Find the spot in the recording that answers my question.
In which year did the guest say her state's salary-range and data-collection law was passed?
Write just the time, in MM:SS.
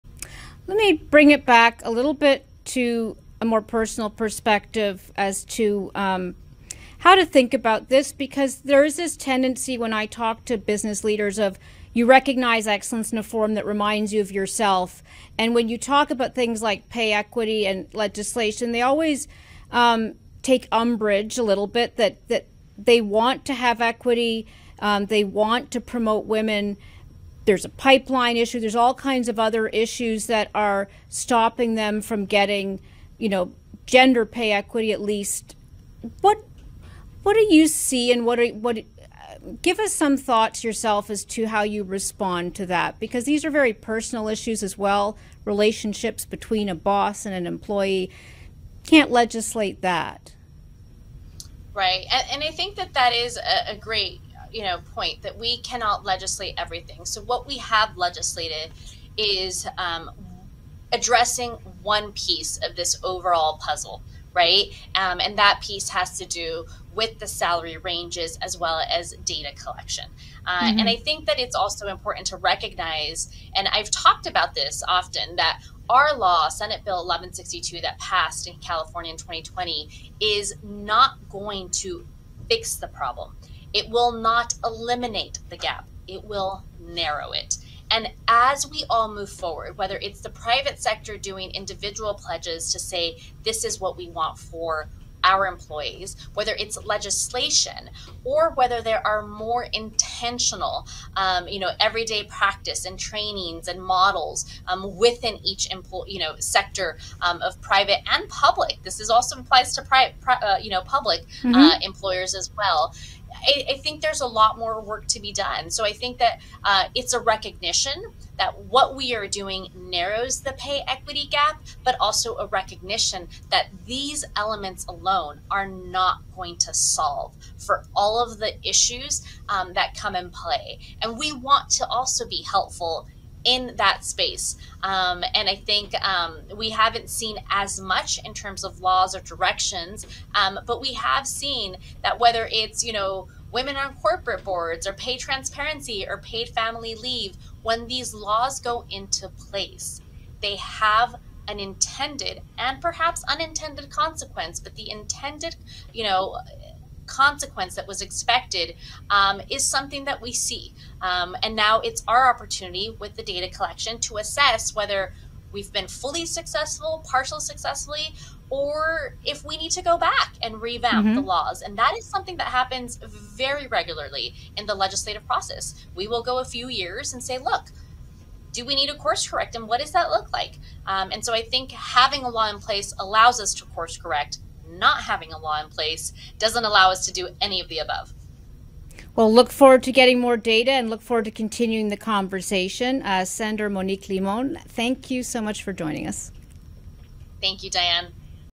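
01:19.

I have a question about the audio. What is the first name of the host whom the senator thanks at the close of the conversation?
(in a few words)
Diane.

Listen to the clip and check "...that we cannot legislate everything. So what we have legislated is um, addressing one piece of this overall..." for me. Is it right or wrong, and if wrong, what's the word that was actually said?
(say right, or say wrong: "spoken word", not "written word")
right.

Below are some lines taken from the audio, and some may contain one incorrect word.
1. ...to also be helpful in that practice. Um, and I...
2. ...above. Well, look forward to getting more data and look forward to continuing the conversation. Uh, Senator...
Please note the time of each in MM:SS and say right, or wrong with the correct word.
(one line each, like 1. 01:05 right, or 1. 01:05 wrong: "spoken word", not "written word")
1. 02:11 wrong: "space", not "practice"
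2. 03:07 right.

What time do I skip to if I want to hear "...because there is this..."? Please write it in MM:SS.
00:08.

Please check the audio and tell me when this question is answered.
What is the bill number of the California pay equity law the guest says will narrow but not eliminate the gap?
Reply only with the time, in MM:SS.
01:16.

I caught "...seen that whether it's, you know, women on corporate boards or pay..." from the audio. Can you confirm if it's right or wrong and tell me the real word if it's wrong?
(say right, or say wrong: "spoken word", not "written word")
right.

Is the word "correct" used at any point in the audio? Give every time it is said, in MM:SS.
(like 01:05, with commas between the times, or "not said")
02:59, 03:03.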